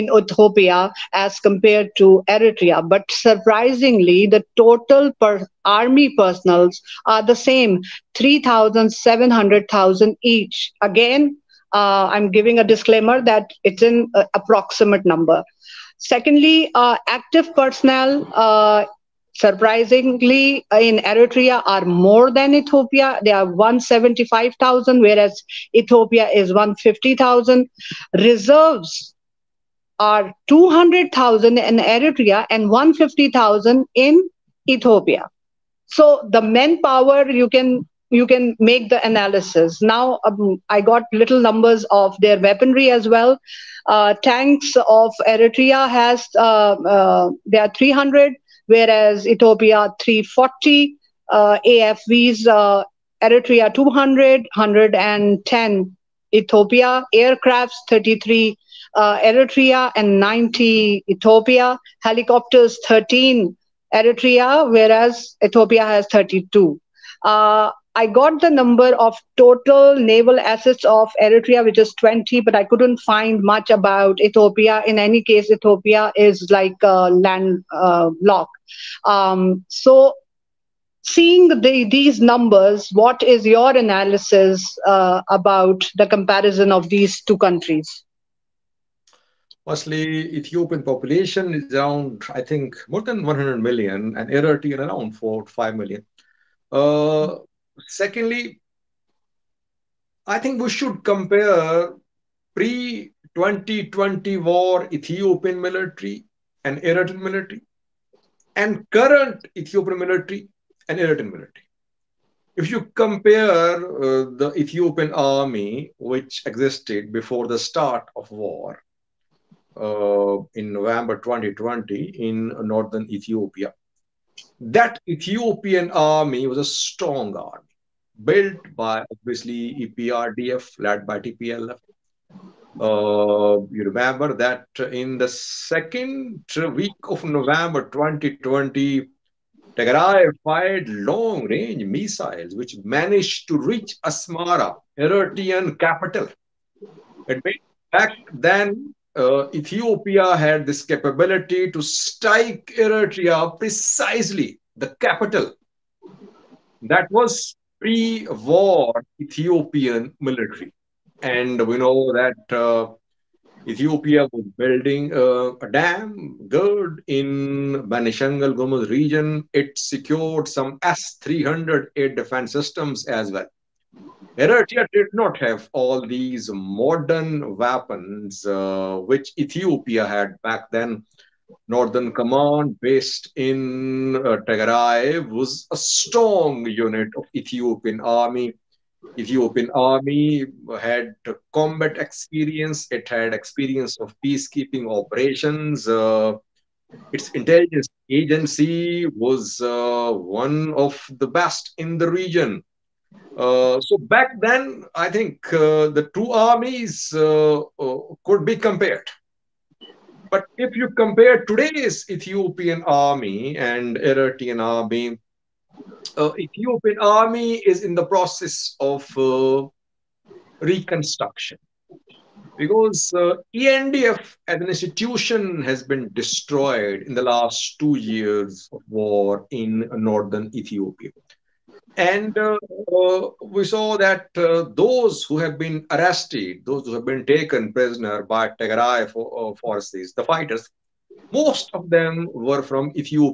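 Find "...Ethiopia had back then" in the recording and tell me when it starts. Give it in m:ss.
2:59.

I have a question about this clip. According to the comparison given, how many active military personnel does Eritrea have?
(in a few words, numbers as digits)
175,000.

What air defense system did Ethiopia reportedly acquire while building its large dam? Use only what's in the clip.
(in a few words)
S-300.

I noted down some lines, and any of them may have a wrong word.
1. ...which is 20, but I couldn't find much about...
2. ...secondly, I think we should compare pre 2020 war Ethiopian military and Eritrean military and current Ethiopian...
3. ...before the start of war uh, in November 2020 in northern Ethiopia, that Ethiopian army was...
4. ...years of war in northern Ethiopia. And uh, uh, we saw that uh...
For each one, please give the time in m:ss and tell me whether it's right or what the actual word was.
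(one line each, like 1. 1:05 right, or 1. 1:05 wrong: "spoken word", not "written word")
1. 1:11 right
2. 1:37 right
3. 1:57 right
4. 3:47 right.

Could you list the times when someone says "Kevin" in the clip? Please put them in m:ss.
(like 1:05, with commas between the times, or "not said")
not said.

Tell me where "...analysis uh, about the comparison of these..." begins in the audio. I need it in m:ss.
1:23.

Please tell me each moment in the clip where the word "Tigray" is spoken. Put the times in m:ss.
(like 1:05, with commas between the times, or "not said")
2:19, 3:04, 3:58.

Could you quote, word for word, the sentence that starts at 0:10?
Again, uh, I'm giving a disclaimer that it's an uh, approximate number.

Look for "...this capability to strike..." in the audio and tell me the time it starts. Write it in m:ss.
2:30.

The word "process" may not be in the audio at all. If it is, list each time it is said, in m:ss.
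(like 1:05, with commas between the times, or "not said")
3:38.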